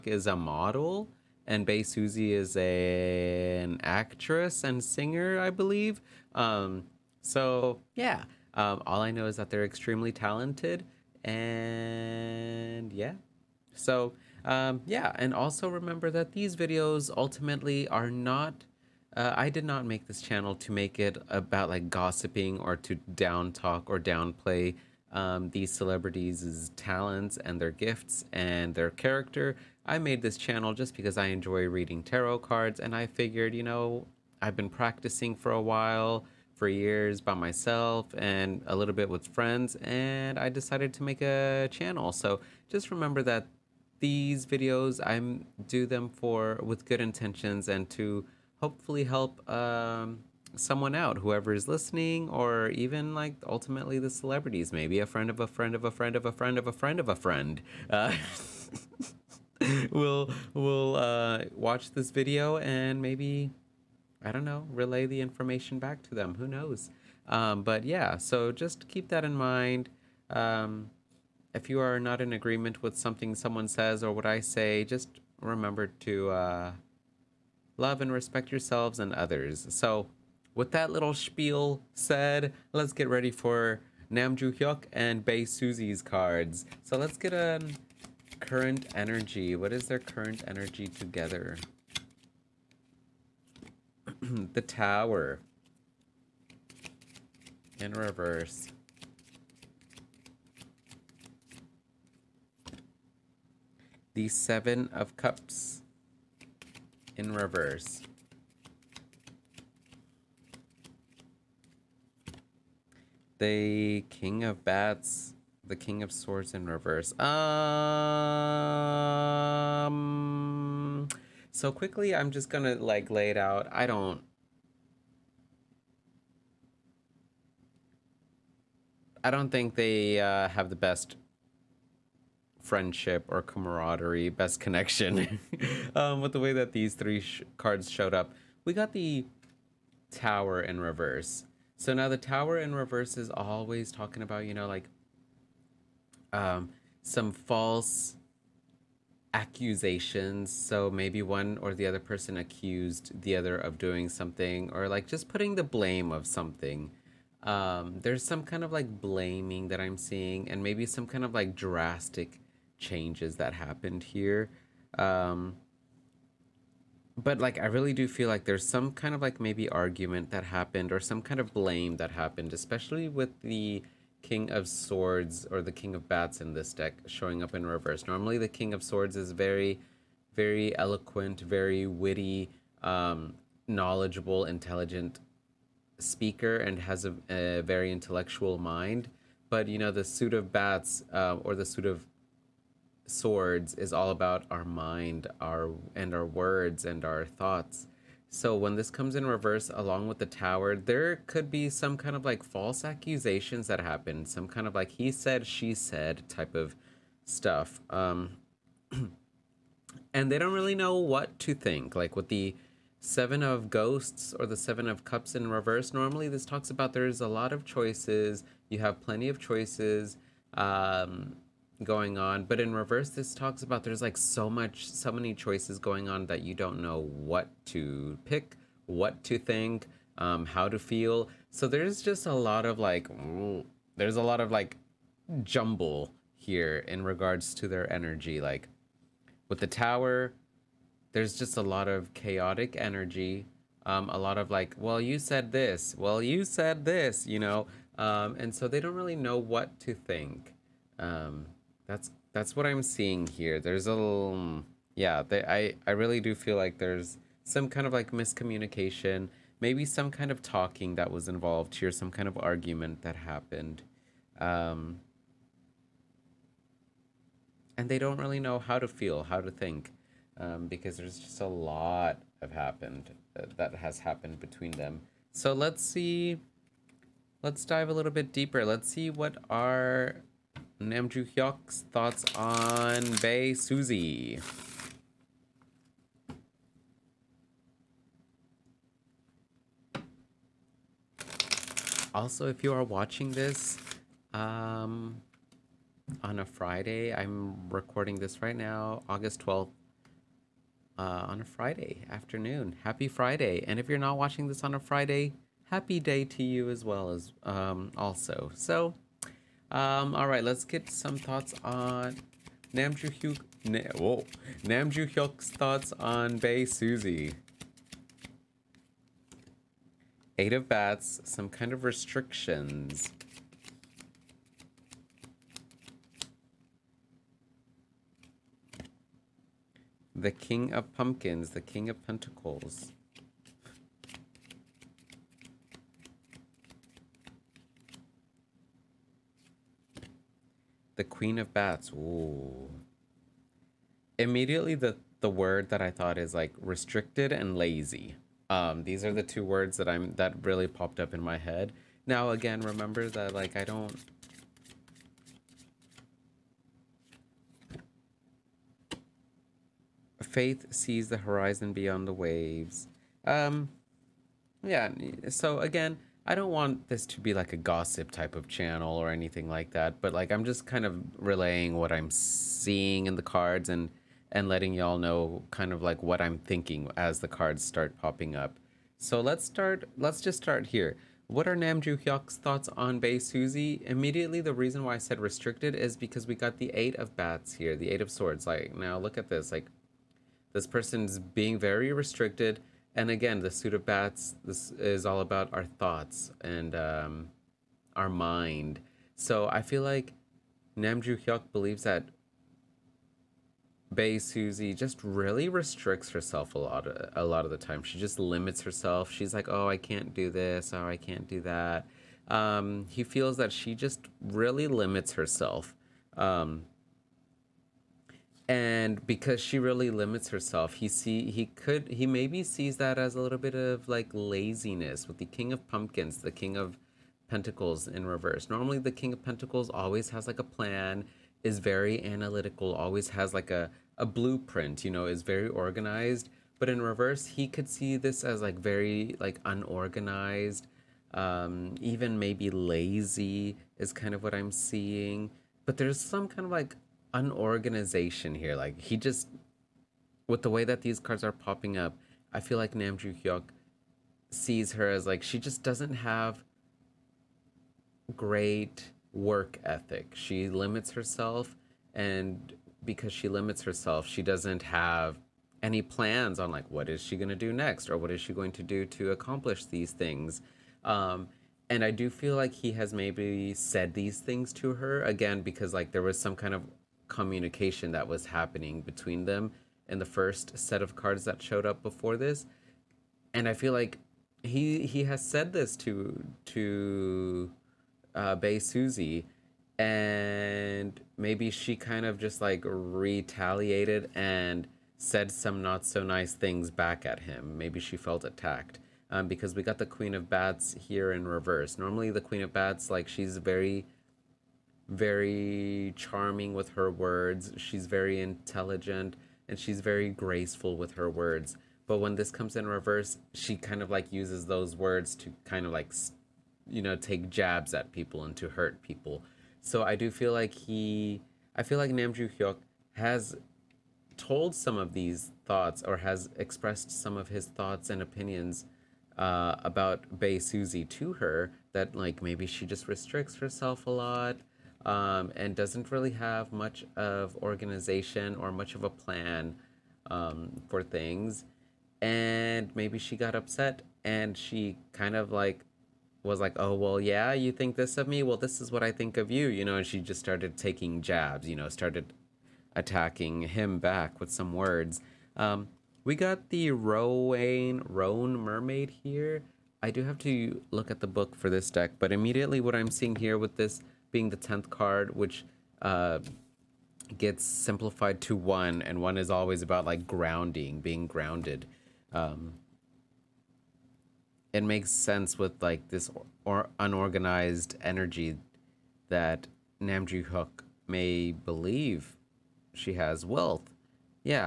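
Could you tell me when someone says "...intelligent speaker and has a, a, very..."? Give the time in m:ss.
3:04.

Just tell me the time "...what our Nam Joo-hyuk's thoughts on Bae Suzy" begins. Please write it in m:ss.
4:39.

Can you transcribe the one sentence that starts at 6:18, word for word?
So let's start let's just start here.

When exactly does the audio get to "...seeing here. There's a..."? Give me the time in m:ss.
4:12.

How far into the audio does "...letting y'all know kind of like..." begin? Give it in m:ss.
6:14.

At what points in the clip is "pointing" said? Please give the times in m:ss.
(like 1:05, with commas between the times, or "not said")
not said.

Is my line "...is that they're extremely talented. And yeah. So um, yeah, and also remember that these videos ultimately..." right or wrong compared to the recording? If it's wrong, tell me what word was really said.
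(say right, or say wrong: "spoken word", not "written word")
right.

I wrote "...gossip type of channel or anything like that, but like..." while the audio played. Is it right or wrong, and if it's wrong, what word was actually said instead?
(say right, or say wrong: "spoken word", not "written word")
right.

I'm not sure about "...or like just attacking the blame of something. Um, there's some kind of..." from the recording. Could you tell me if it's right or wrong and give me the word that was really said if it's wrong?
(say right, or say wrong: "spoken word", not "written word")
wrong: "putting", not "attacking".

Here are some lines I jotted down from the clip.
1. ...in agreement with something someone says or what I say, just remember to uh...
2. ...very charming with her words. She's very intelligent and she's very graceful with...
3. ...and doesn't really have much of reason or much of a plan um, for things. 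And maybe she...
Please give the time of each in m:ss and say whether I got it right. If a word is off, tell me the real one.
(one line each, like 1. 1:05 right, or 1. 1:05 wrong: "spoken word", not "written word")
1. 1:12 right
2. 8:24 right
3. 8:55 wrong: "organization", not "reason".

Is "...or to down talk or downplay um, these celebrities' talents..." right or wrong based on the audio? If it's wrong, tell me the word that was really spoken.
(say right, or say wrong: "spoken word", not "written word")
right.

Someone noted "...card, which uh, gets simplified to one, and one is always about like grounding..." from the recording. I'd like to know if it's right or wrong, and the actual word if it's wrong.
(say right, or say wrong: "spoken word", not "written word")
right.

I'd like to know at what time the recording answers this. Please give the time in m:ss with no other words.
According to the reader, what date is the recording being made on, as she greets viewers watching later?
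4:59.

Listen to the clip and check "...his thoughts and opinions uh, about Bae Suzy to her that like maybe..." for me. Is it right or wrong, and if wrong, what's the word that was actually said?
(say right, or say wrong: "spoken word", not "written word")
right.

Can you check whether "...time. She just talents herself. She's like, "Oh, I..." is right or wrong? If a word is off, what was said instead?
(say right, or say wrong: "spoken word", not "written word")
wrong: "limits", not "talents".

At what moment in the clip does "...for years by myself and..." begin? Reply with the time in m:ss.
0:36.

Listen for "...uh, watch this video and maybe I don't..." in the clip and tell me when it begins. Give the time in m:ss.
1:00.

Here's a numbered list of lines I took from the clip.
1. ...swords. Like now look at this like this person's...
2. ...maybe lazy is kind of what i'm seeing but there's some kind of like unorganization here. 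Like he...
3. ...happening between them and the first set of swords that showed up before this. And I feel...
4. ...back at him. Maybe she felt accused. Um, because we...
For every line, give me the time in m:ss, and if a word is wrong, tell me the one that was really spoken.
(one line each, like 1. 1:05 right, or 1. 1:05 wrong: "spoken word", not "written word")
1. 6:28 right
2. 7:22 right
3. 7:58 wrong: "cards", not "swords"
4. 8:16 wrong: "attacked", not "accused".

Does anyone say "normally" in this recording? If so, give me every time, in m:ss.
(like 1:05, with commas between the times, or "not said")
2:58, 3:35, 7:08, 8:21.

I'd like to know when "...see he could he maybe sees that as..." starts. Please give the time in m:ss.
7:00.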